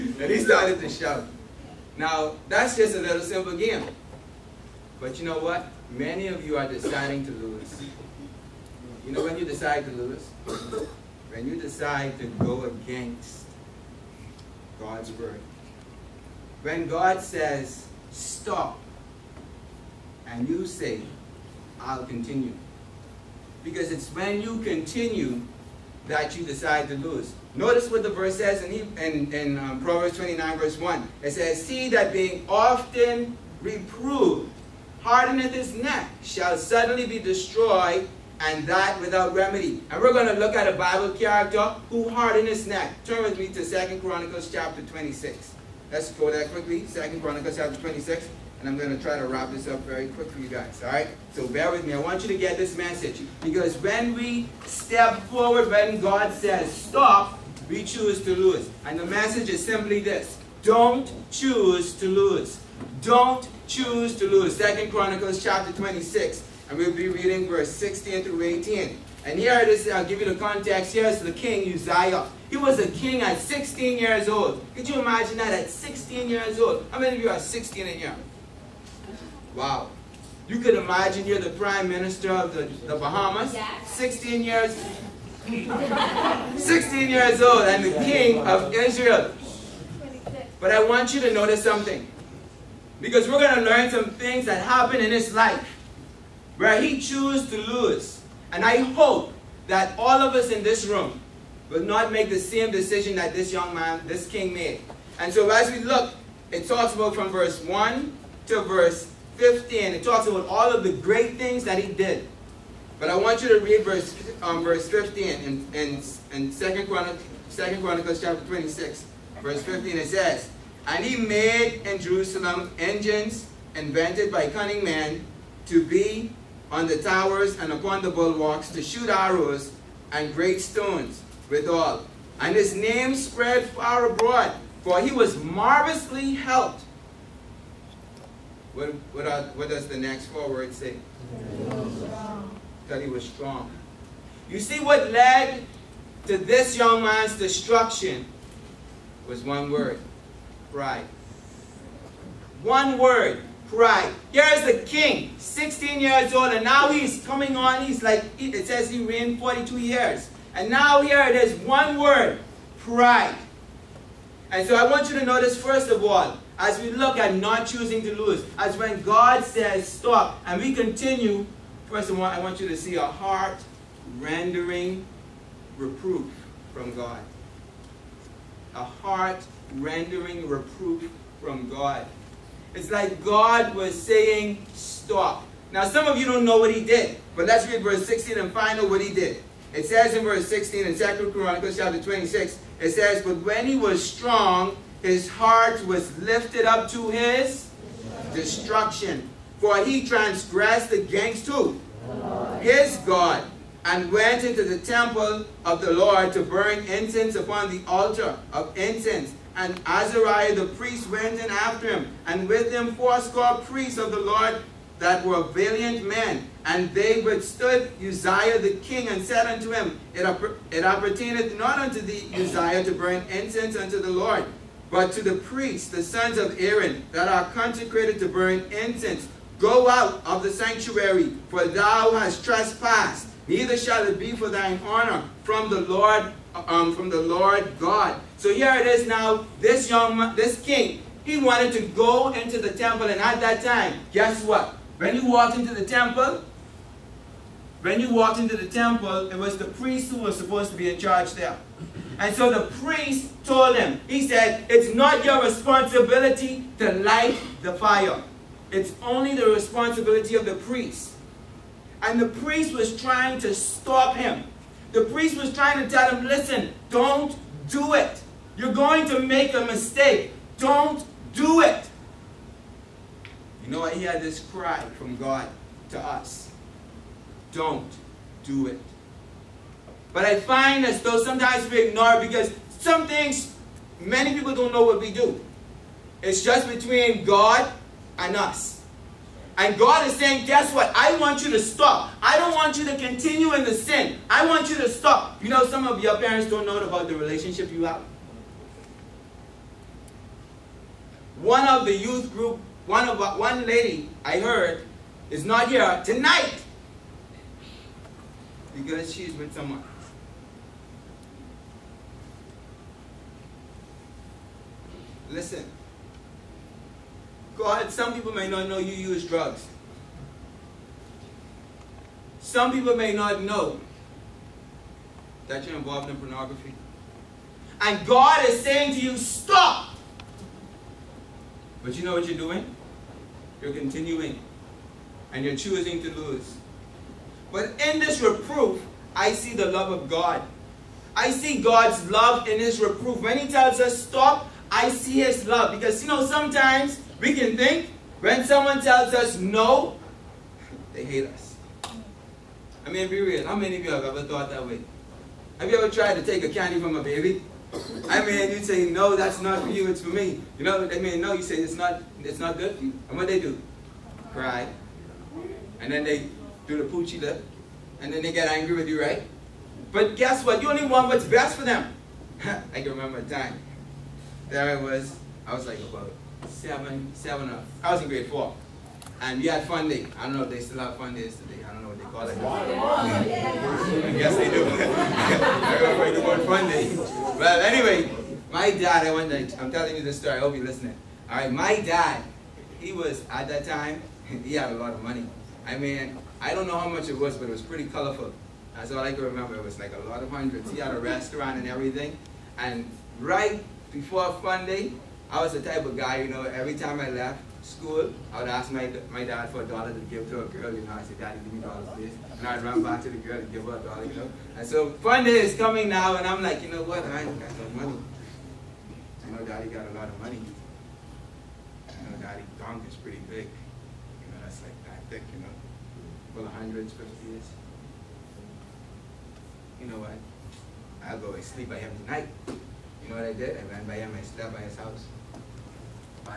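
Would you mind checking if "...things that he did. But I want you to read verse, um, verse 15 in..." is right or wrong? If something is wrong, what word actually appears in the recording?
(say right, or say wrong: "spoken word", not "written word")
right.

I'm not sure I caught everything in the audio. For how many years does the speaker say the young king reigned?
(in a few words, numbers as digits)
42.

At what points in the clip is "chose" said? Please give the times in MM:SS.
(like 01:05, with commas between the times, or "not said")
01:37.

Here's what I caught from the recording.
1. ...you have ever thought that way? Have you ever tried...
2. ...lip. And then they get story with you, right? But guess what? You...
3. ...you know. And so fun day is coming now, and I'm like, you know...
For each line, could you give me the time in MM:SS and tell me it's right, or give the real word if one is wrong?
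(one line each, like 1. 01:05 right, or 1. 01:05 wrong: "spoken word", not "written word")
1. 05:53 right
2. 06:07 wrong: "angry", not "story"
3. 06:54 right.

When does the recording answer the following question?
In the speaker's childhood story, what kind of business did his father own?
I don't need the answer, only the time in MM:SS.
06:40.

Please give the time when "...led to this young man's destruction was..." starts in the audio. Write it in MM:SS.
02:25.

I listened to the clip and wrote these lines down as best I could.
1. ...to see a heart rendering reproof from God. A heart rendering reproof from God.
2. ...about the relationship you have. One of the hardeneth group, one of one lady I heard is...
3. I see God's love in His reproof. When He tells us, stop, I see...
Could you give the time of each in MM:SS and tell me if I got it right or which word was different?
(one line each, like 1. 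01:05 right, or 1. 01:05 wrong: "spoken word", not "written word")
1. 02:52 right
2. 04:56 wrong: "youth", not "hardeneth"
3. 05:41 right.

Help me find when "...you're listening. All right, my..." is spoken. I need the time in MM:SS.
06:30.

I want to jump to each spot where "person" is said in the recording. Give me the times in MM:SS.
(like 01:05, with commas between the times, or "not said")
not said.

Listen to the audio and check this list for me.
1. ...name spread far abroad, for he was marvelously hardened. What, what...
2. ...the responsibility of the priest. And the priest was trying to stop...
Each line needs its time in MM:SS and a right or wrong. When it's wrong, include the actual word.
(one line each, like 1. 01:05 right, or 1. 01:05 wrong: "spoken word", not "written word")
1. 02:12 wrong: "helped", not "hardened"
2. 04:19 right.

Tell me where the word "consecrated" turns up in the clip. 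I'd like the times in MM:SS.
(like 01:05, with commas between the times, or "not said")
03:47.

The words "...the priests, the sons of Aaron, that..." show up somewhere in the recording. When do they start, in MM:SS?
03:45.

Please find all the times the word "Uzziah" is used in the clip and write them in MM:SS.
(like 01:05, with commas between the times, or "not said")
01:11, 03:38, 03:42.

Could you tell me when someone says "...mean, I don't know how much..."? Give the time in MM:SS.
06:35.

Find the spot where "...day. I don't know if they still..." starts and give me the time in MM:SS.
06:19.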